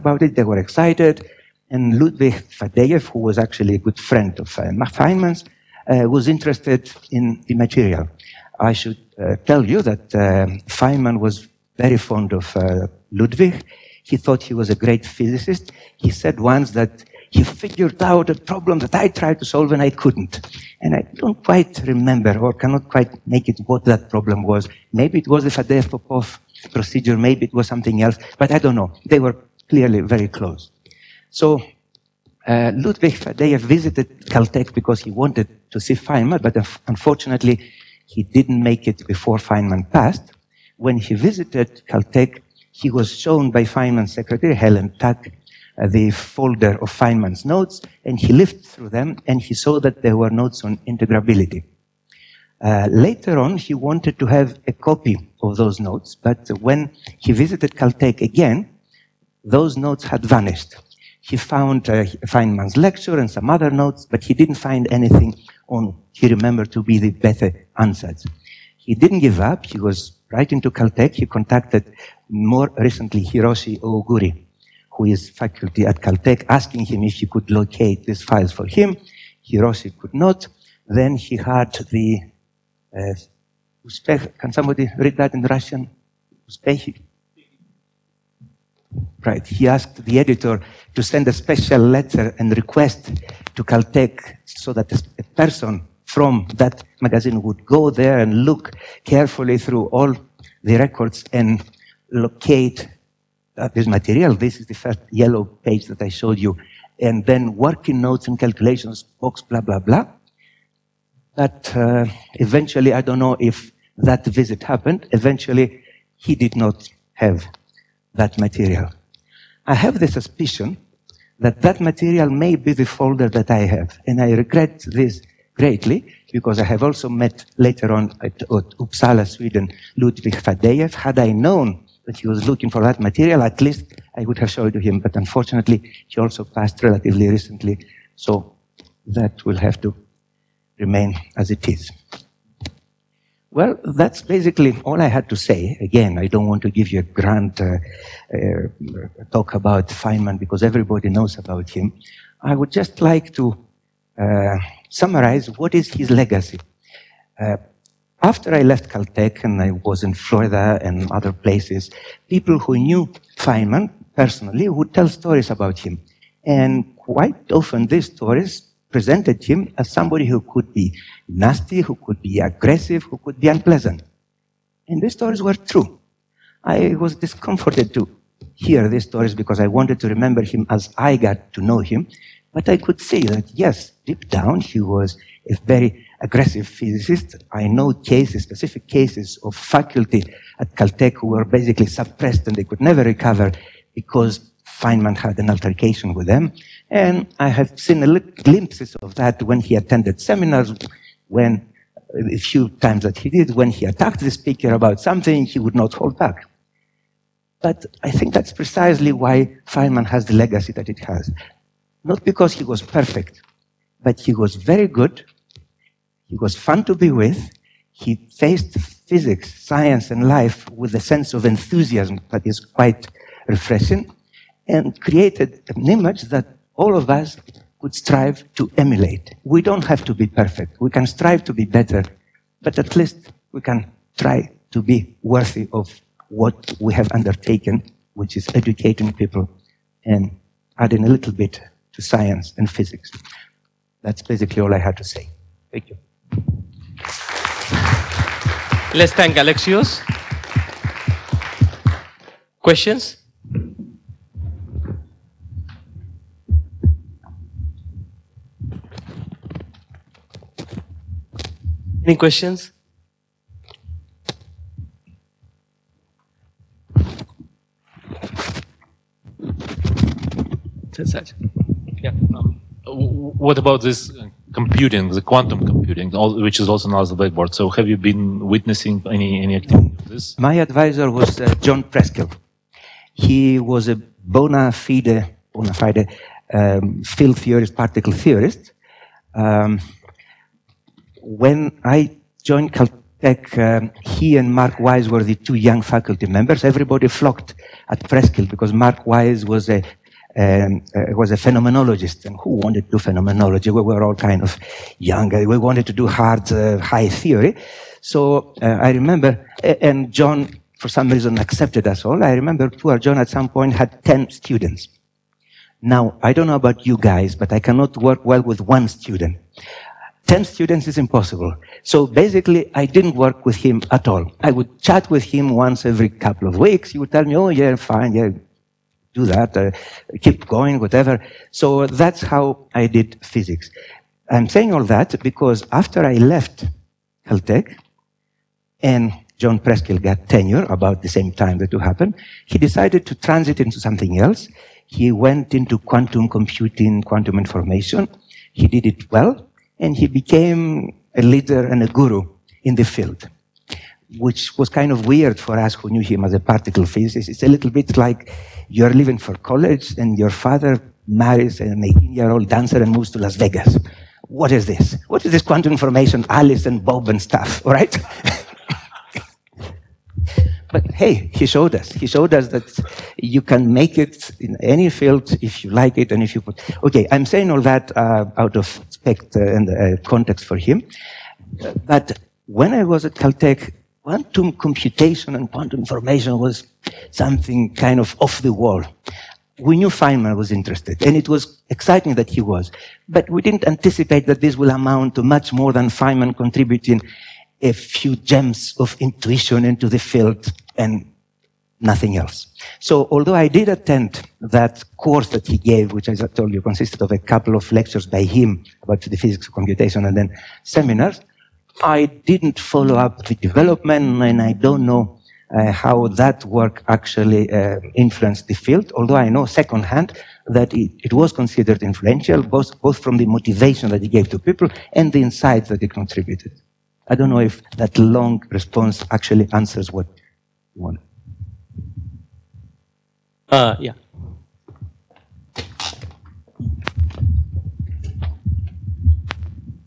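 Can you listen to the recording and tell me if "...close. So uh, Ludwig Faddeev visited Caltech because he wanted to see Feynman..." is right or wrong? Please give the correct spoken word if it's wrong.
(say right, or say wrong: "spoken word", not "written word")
right.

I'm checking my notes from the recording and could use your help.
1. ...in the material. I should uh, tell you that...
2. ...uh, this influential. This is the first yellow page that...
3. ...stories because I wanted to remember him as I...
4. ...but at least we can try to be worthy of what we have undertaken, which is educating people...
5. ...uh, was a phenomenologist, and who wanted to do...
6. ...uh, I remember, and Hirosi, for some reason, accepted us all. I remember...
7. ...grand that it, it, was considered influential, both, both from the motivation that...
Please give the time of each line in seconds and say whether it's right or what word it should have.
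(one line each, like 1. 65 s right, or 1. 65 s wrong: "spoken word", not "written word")
1. 7 s right
2. 103 s wrong: "material", not "influential"
3. 179 s right
4. 232 s right
5. 300 s right
6. 308 s wrong: "John", not "Hirosi"
7. 419 s wrong: "secondhand", not "grand".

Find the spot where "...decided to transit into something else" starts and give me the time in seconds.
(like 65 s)
342 s.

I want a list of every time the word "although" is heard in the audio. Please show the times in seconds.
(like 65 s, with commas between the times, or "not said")
403 s, 418 s.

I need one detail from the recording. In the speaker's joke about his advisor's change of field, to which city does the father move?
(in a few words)
Las Vegas.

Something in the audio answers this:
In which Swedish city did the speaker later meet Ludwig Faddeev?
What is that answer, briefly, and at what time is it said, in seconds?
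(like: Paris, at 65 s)
Uppsala, at 128 s.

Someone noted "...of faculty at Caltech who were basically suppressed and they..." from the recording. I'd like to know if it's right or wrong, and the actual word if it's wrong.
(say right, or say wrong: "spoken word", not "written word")
right.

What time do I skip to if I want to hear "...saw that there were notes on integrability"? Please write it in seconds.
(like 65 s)
49 s.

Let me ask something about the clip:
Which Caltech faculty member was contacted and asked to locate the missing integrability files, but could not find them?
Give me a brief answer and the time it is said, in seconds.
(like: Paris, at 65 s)
Hirosi Ooguri, at 73 s.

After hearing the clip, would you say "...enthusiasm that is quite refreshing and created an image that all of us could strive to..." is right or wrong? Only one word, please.
right.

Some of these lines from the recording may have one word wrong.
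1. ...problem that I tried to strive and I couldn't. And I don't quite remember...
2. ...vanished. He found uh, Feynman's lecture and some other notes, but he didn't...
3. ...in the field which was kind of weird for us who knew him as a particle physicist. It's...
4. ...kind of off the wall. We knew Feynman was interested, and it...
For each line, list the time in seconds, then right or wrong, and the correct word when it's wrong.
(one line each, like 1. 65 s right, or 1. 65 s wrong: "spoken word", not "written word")
1. 18 s wrong: "solve", not "strive"
2. 60 s right
3. 352 s right
4. 387 s right.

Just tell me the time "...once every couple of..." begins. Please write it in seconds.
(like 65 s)
325 s.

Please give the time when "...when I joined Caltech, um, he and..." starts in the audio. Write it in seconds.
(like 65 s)
291 s.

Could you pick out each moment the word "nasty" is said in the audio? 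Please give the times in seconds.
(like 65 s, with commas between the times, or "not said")
171 s.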